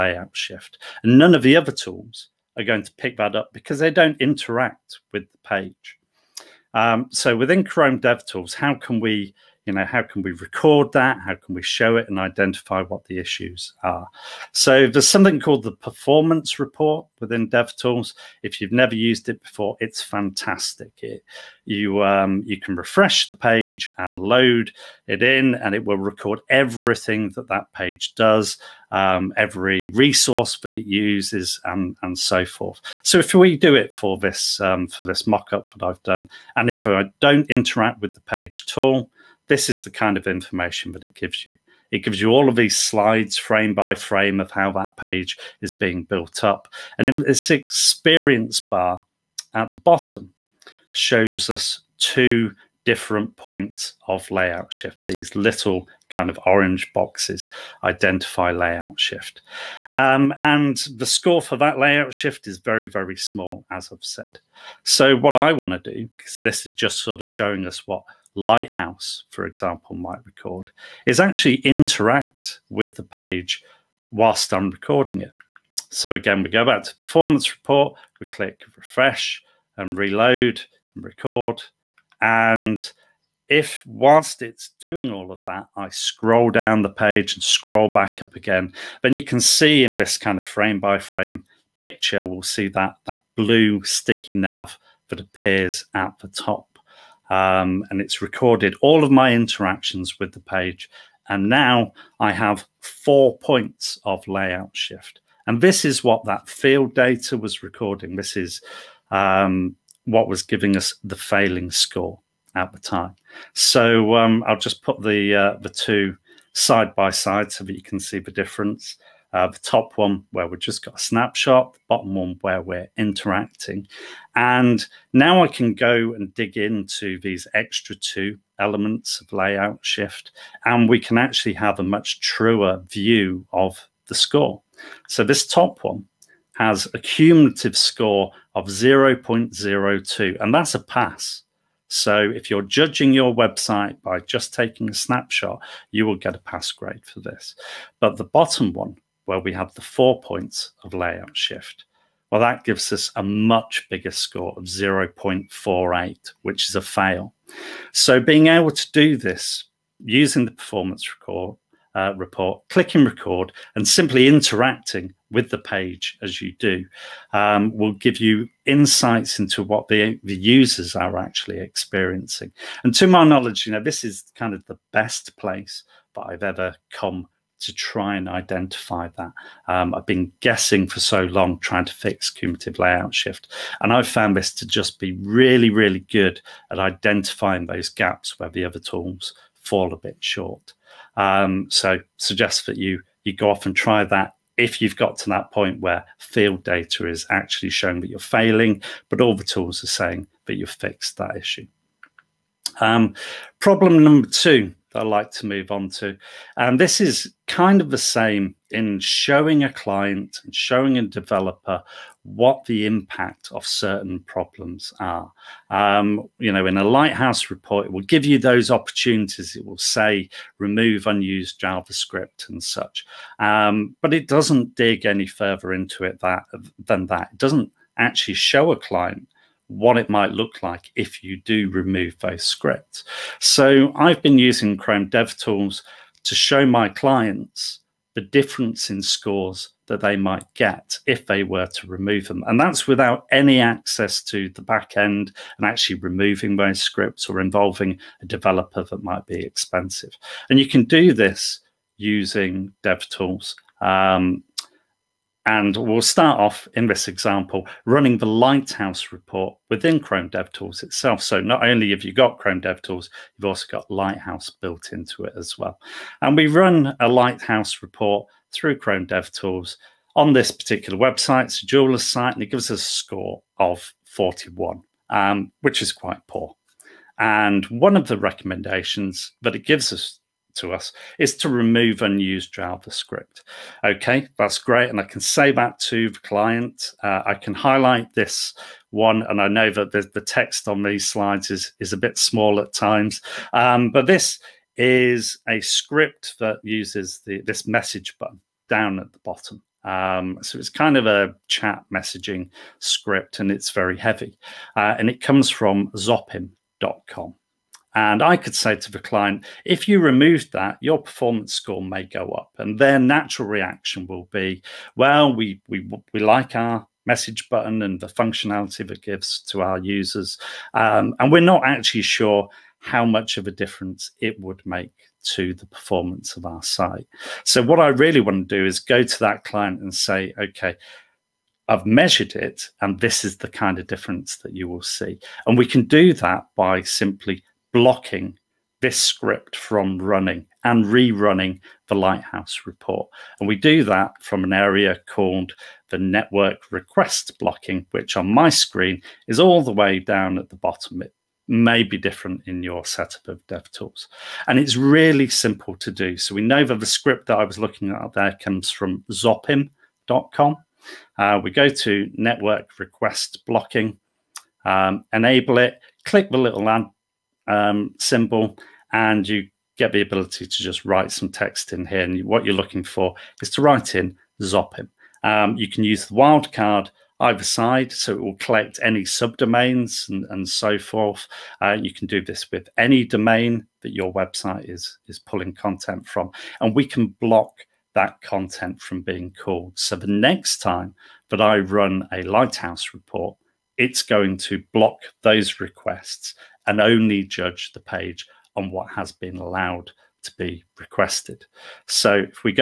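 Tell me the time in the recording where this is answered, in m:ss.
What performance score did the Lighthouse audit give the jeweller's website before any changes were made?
4:34.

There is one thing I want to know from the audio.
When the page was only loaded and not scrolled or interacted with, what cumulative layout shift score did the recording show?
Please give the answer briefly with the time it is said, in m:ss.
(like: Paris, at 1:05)
0.02, at 2:18.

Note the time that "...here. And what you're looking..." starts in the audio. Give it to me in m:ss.
6:11.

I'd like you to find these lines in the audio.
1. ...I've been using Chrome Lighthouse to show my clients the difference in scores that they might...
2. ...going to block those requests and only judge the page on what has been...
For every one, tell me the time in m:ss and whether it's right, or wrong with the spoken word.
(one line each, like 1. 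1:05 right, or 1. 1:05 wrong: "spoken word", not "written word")
1. 3:53 wrong: "DevTools", not "Lighthouse"
2. 6:34 right.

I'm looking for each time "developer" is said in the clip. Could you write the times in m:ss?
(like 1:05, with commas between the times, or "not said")
3:31, 4:08.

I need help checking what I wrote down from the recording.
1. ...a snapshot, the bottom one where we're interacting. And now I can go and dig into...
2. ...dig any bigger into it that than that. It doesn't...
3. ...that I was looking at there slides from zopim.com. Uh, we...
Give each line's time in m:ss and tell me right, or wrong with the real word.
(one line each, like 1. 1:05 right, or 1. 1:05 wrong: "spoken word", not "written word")
1. 2:00 right
2. 3:44 wrong: "further", not "bigger"
3. 5:57 wrong: "comes", not "slides".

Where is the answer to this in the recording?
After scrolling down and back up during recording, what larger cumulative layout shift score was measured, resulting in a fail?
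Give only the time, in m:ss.
2:34.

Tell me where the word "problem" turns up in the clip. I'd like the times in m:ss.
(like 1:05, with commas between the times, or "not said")
3:23, 3:34.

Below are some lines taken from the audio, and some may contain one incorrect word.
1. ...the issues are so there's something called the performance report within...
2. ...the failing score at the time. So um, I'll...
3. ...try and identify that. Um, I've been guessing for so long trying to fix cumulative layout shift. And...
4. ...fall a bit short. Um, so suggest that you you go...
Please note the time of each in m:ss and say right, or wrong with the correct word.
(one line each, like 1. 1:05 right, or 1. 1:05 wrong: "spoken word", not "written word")
1. 0:13 right
2. 1:51 right
3. 2:57 right
4. 3:09 right.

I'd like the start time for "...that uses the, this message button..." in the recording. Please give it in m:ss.
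4:56.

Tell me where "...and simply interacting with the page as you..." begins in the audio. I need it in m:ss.
2:43.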